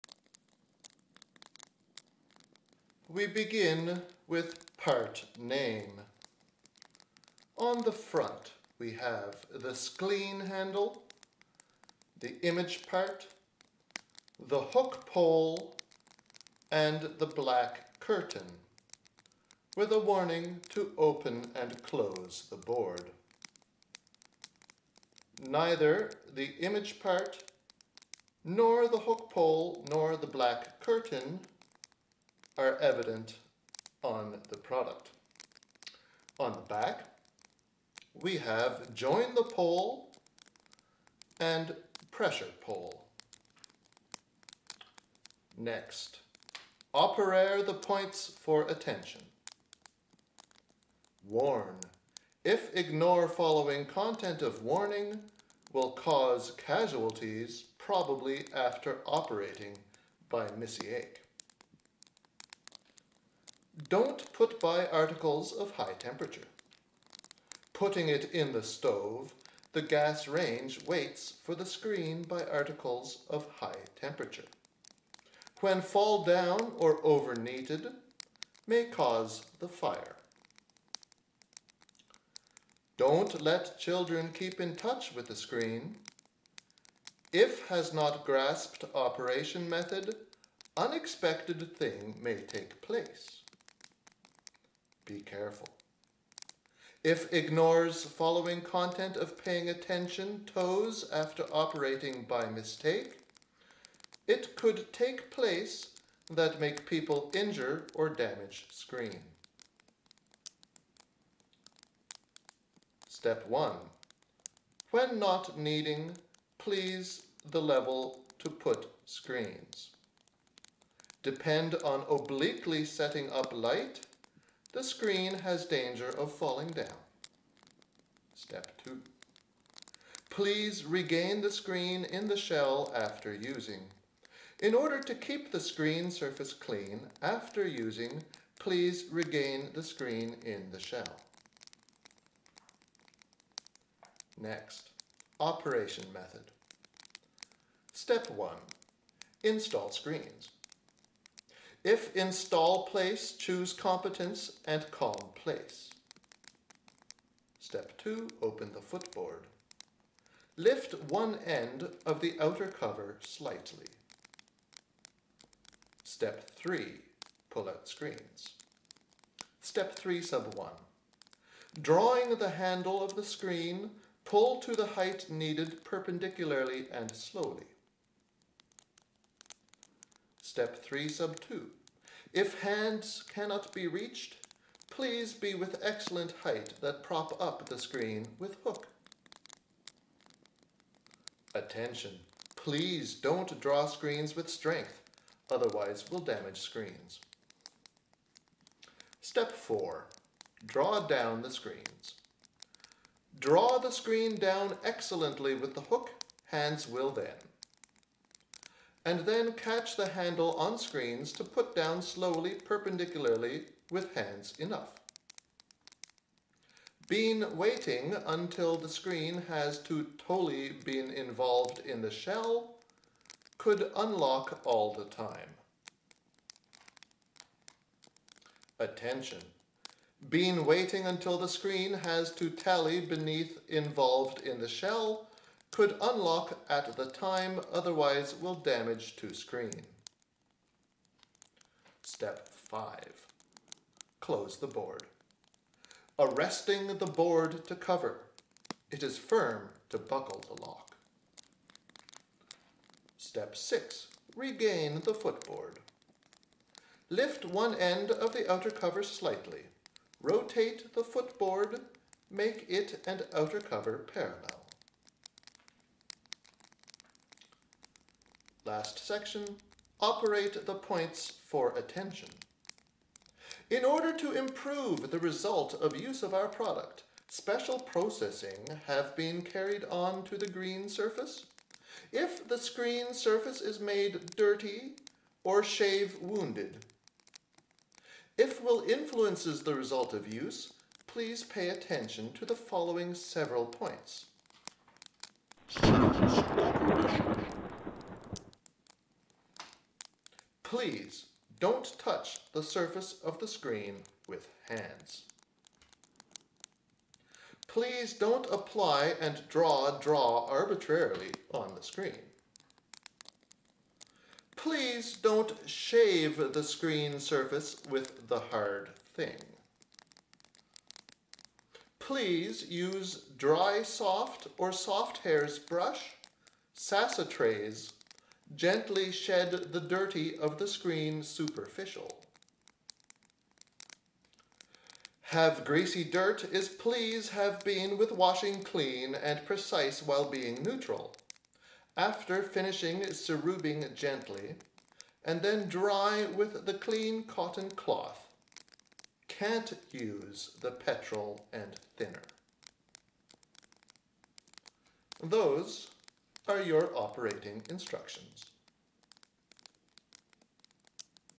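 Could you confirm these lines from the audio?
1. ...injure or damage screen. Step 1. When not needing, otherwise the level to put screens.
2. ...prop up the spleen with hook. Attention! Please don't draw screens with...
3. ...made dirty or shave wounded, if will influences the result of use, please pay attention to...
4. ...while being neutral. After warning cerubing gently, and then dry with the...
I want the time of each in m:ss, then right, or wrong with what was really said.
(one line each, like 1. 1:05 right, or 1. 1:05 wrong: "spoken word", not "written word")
1. 1:47 wrong: "please", not "otherwise"
2. 3:07 wrong: "screen", not "spleen"
3. 4:43 right
4. 5:40 wrong: "finishing", not "warning".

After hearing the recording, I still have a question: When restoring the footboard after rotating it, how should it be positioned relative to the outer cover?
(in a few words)
parallel.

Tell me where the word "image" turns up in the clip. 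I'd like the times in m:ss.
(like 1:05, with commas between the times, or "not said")
0:12, 0:26.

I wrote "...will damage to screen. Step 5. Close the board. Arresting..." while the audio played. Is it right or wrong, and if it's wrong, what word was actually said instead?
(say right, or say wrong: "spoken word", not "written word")
right.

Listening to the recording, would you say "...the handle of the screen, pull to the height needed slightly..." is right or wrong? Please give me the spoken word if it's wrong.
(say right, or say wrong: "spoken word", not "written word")
wrong: "perpendicularly", not "slightly".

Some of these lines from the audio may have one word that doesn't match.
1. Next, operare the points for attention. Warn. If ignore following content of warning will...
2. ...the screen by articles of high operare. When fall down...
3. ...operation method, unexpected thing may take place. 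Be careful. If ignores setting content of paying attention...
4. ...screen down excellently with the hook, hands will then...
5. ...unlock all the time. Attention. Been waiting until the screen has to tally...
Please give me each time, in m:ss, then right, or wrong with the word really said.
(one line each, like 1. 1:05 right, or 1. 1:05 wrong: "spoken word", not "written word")
1. 0:45 right
2. 1:11 wrong: "temperature", not "operare"
3. 1:28 wrong: "following", not "setting"
4. 3:23 right
5. 3:43 right.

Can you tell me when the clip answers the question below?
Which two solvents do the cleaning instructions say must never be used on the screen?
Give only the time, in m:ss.
5:50.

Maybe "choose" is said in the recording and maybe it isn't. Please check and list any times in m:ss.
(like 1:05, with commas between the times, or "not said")
2:33.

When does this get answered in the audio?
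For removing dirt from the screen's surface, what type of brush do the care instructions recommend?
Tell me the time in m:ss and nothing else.
5:24.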